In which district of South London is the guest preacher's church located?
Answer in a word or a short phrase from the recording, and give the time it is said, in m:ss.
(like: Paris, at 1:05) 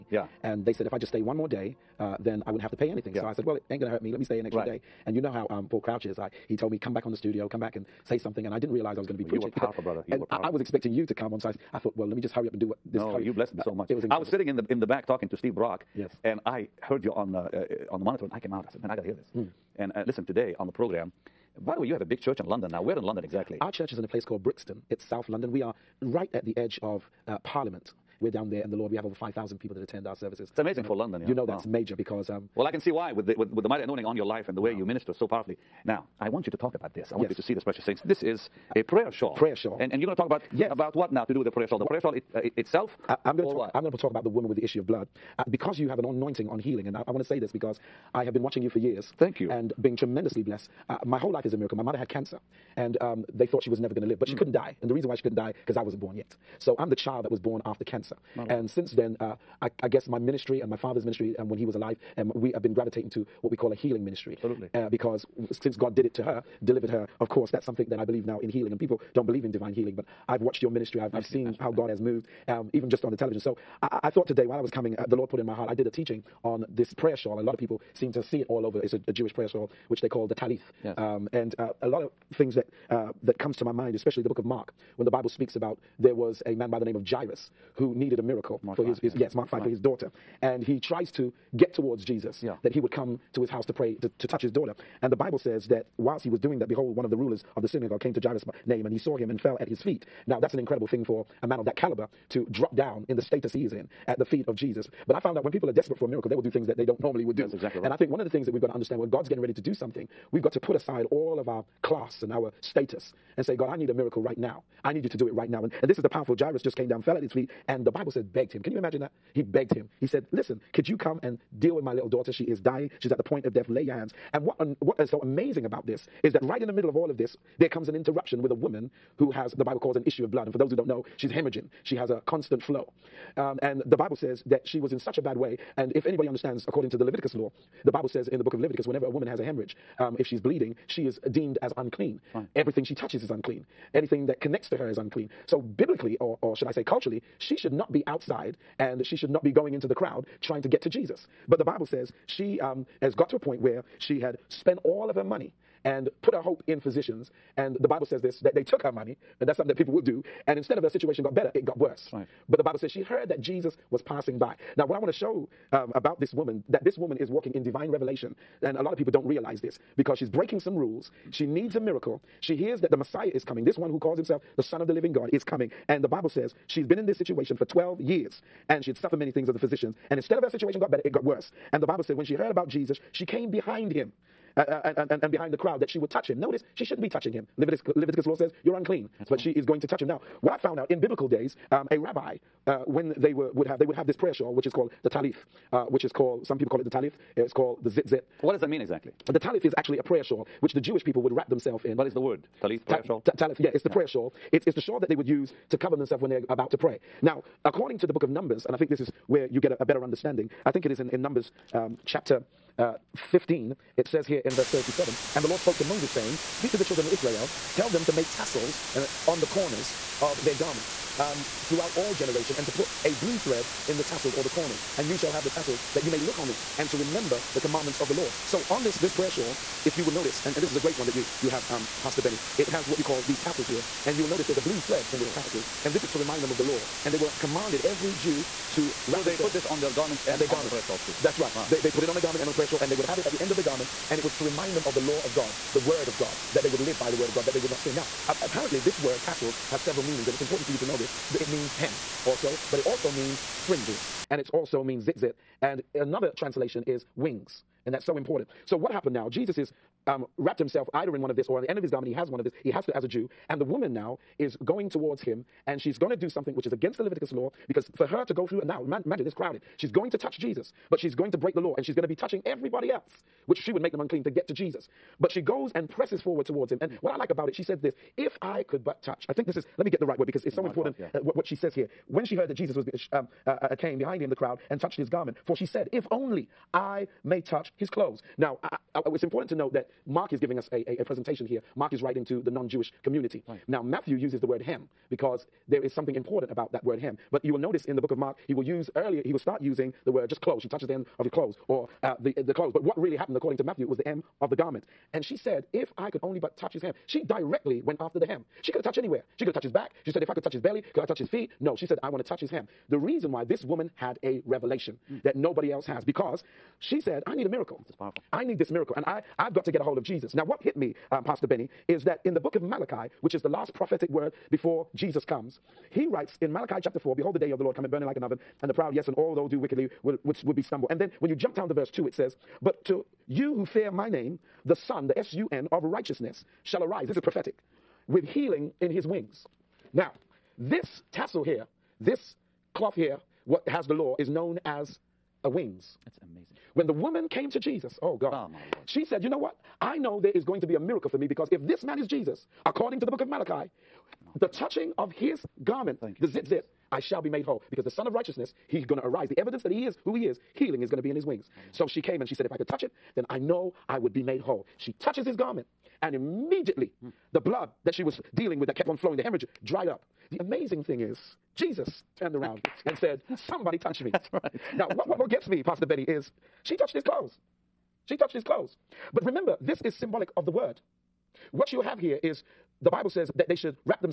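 Brixton, at 0:24.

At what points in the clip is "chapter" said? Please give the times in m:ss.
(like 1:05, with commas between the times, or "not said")
3:32, 5:26.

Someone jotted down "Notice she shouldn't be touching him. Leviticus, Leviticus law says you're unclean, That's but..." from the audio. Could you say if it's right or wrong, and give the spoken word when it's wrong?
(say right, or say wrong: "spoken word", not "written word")
right.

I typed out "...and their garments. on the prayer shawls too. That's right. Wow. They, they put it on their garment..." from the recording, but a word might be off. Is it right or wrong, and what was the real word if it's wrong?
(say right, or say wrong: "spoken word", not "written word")
right.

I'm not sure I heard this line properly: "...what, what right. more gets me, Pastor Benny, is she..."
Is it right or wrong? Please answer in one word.
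right.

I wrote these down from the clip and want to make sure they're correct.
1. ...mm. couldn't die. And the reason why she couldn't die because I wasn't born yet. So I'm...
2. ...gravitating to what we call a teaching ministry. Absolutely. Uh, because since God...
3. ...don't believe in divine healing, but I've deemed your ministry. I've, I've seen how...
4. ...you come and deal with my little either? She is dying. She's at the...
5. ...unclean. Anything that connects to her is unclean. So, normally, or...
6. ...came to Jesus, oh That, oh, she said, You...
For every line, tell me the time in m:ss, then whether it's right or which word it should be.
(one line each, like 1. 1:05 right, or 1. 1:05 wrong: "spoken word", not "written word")
1. 0:54 right
2. 1:02 wrong: "healing", not "teaching"
3. 1:09 wrong: "watched", not "deemed"
4. 2:00 wrong: "daughter", not "either"
5. 2:23 wrong: "biblically", not "normally"
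6. 5:47 wrong: "God", not "That".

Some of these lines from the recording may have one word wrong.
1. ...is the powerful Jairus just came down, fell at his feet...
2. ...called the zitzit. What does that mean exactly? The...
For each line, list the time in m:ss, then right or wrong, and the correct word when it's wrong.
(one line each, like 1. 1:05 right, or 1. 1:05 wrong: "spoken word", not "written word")
1. 1:55 right
2. 3:17 right.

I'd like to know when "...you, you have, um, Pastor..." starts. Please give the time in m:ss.
3:51.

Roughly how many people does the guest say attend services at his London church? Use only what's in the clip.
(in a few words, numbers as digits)
5,000.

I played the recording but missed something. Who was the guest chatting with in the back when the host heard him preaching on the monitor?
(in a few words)
Steve Brock.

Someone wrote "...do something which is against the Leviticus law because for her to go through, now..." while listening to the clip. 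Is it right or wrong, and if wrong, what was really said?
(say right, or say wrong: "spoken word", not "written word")
right.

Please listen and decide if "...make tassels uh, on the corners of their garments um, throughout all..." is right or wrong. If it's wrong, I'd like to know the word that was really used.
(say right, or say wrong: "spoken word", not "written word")
right.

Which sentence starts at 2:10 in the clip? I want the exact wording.
And for those who don't know, she's hemorrhaging, she has a constant flow.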